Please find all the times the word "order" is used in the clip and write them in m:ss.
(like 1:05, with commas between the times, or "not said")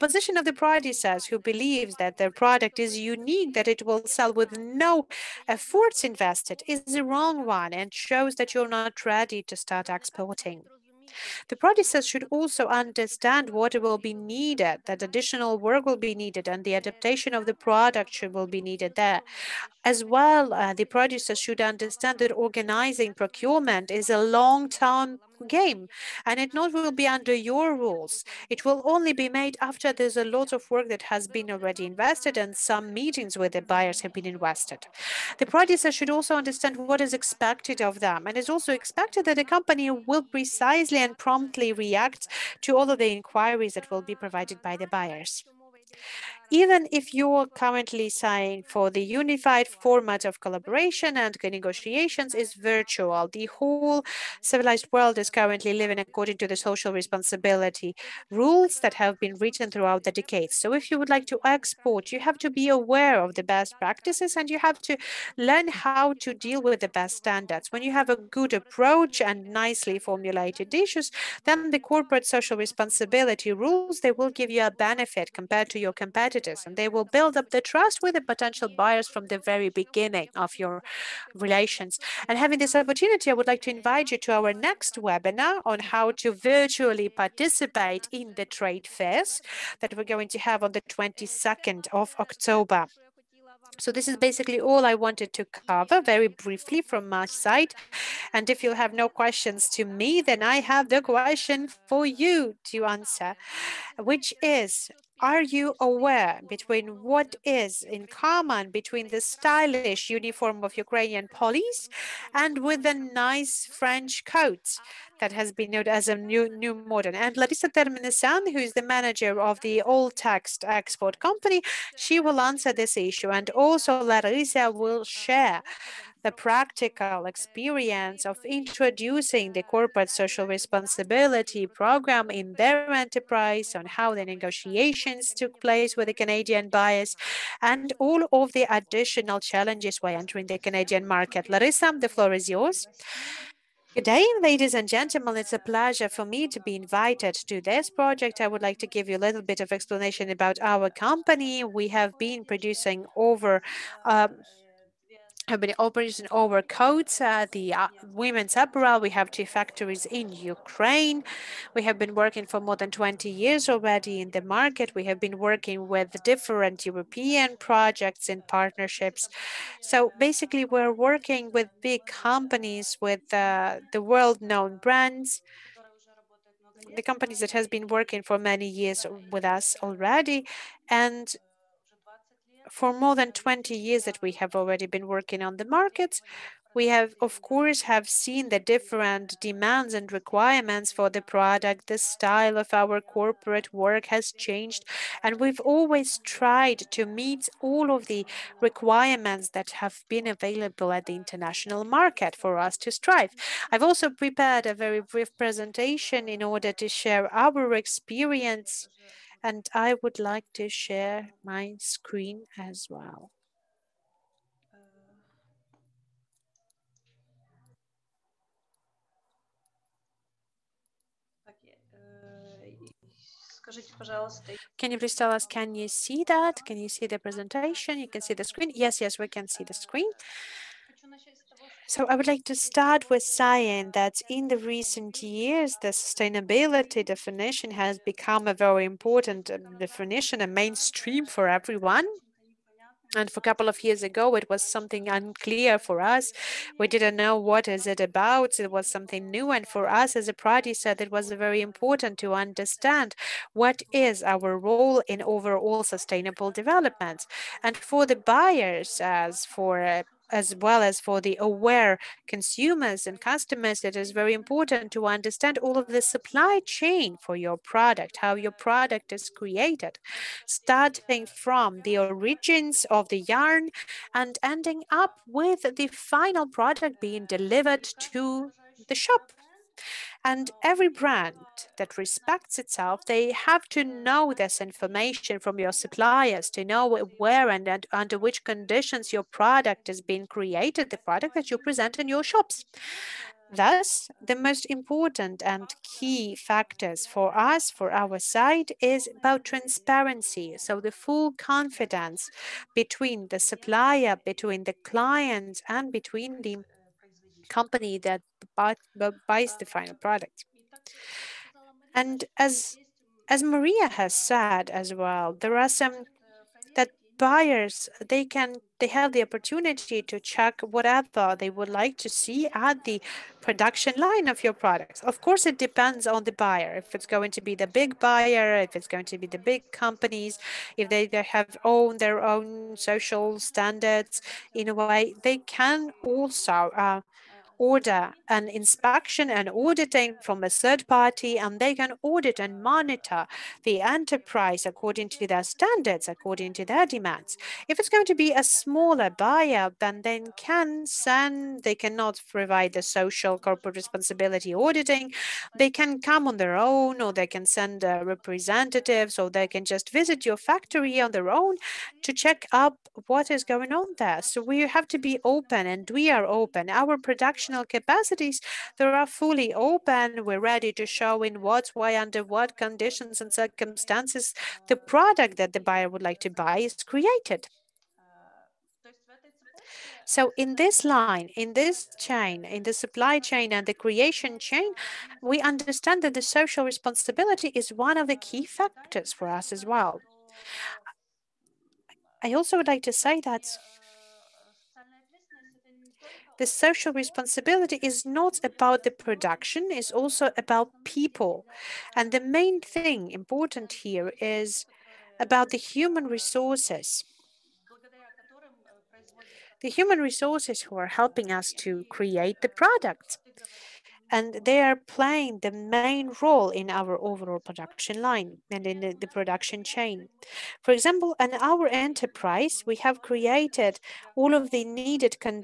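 3:26, 5:37.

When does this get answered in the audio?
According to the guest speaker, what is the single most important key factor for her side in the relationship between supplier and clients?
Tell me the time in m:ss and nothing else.
4:59.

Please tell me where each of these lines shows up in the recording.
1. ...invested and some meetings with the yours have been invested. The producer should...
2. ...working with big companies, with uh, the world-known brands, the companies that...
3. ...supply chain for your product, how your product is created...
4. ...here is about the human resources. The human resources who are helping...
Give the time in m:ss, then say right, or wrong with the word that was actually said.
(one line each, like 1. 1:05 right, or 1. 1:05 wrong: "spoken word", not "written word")
1. 0:31 wrong: "buyers", not "yours"
2. 2:50 right
3. 4:26 right
4. 6:43 right.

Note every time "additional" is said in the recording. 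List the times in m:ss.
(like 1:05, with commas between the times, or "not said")
0:15, 2:18.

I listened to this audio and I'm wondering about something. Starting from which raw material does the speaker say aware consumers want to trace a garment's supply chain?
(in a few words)
Yarn.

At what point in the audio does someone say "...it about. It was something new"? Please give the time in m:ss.
4:07.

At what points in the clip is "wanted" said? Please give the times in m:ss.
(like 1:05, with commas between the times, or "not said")
1:35.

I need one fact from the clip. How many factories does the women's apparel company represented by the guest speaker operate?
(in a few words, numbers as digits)
2.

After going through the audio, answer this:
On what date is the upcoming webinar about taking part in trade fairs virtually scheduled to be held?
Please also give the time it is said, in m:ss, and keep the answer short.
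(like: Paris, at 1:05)
22 October, at 1:30.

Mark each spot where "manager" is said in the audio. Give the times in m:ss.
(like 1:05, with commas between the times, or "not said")
1:58.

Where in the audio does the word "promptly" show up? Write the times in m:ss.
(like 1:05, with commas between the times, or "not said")
0:41.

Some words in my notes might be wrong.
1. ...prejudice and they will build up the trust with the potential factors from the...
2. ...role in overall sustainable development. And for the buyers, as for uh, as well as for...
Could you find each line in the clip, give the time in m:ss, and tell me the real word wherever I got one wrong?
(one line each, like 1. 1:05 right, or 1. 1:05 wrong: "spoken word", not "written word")
1. 1:16 wrong: "buyers", not "factors"
2. 4:14 right.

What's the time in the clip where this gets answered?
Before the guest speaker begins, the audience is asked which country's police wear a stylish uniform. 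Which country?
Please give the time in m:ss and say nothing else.
1:50.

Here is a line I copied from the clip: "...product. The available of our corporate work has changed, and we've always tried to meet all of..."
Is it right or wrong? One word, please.
wrong.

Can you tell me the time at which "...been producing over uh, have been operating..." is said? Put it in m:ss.
2:32.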